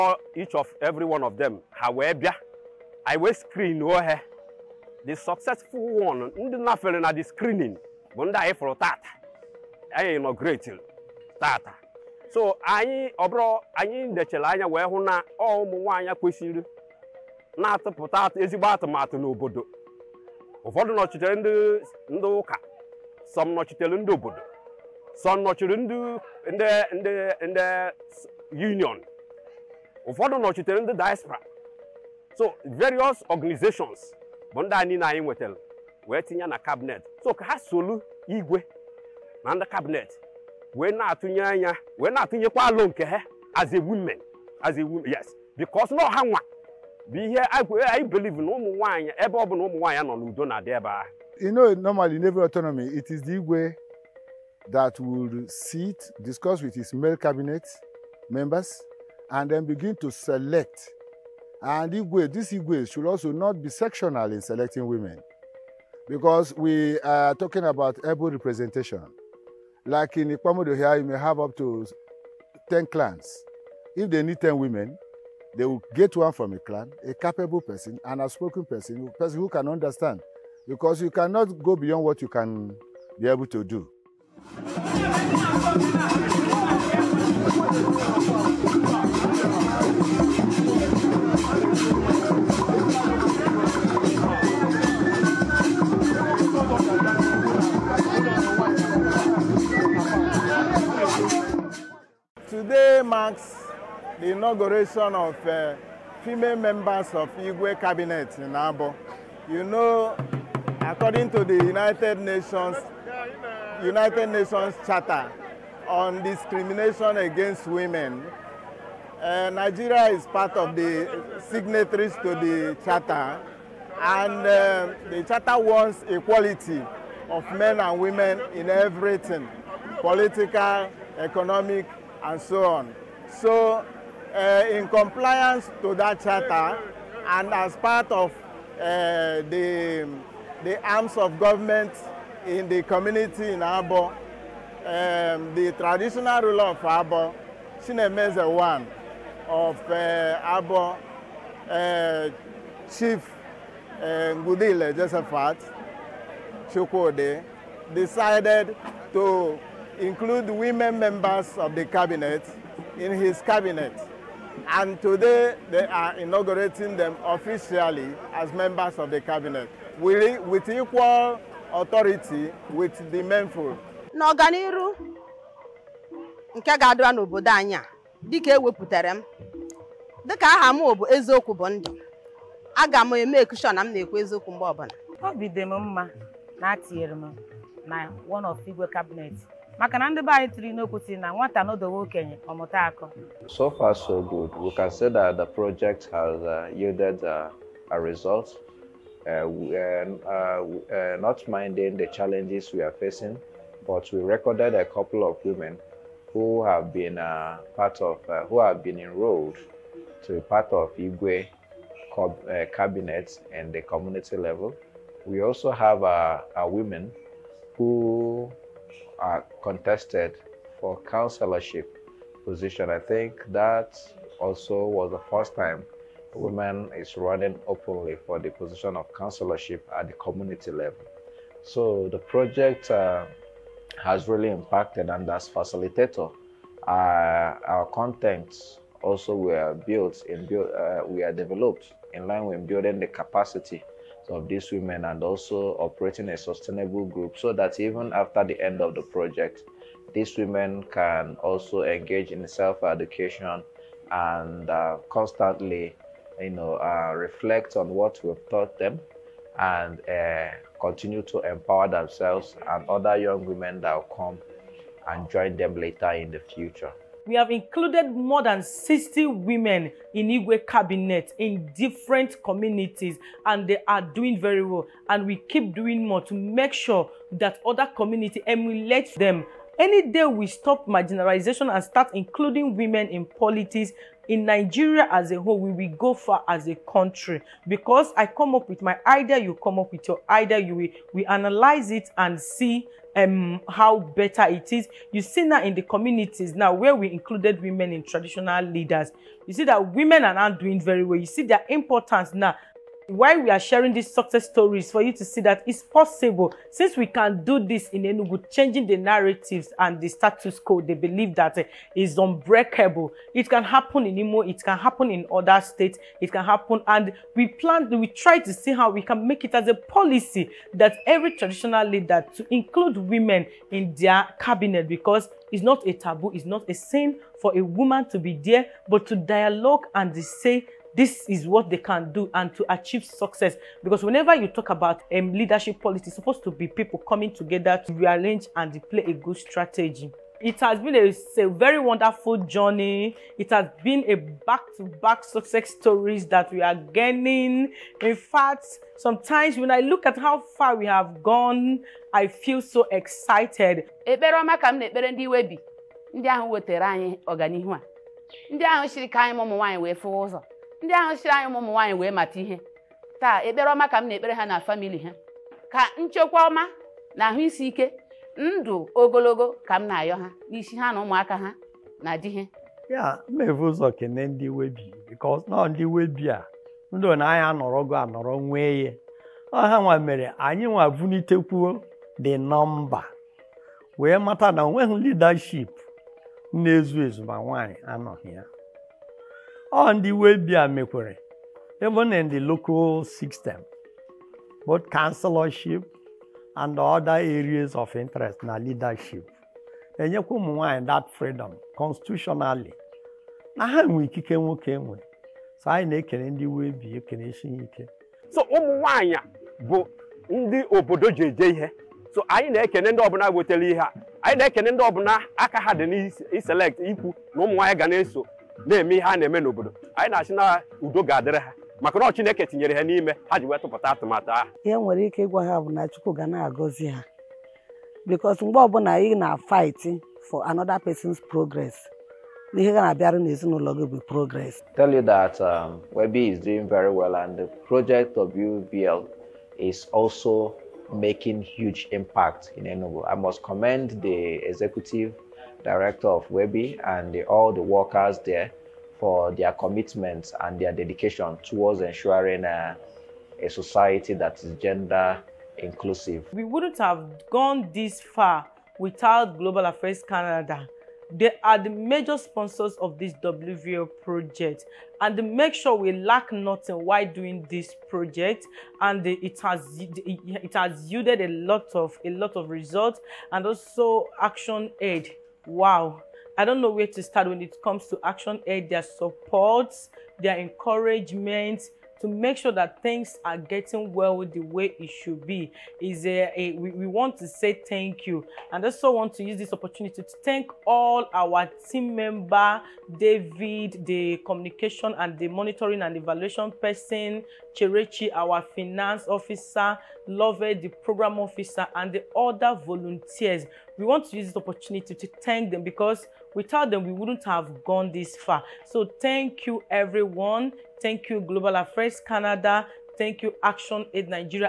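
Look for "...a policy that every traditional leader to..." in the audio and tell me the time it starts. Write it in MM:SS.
05:19.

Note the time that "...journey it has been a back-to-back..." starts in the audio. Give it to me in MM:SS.
05:42.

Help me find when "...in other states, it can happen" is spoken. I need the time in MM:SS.
05:15.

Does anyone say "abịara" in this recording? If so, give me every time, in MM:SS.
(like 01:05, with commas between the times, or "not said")
07:12.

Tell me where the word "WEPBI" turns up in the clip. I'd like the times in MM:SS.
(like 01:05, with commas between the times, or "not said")
07:15, 07:26.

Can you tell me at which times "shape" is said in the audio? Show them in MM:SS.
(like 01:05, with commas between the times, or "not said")
not said.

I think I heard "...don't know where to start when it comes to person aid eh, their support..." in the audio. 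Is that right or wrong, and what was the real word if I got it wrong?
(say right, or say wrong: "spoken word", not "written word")
wrong: "action", not "person".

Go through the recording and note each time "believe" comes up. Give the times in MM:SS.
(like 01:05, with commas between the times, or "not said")
00:48, 05:10.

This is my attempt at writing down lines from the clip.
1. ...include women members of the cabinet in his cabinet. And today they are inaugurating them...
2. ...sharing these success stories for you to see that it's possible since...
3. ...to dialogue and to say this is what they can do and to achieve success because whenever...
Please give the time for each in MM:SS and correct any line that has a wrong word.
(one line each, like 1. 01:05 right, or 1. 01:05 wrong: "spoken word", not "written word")
1. 02:40 right
2. 05:03 right
3. 05:29 right.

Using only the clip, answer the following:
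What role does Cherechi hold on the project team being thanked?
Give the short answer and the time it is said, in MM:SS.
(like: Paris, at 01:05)
Finance officer, at 08:18.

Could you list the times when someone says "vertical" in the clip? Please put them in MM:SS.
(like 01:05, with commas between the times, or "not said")
not said.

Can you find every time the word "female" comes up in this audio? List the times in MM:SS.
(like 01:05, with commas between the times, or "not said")
01:46.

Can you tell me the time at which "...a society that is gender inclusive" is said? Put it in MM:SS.
07:33.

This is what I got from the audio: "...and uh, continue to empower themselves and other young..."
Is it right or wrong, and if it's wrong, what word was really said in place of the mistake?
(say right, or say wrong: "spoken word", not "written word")
right.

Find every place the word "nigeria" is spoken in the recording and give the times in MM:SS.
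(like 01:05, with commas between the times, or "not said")
01:59, 04:44.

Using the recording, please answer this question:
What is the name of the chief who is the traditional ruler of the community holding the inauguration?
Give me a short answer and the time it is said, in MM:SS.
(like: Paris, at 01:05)
Josephat Chukwode, at 02:34.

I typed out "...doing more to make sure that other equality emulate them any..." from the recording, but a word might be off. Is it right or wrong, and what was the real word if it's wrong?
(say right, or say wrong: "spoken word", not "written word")
wrong: "community", not "equality".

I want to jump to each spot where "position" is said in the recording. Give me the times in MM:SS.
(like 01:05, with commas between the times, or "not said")
03:42, 03:48.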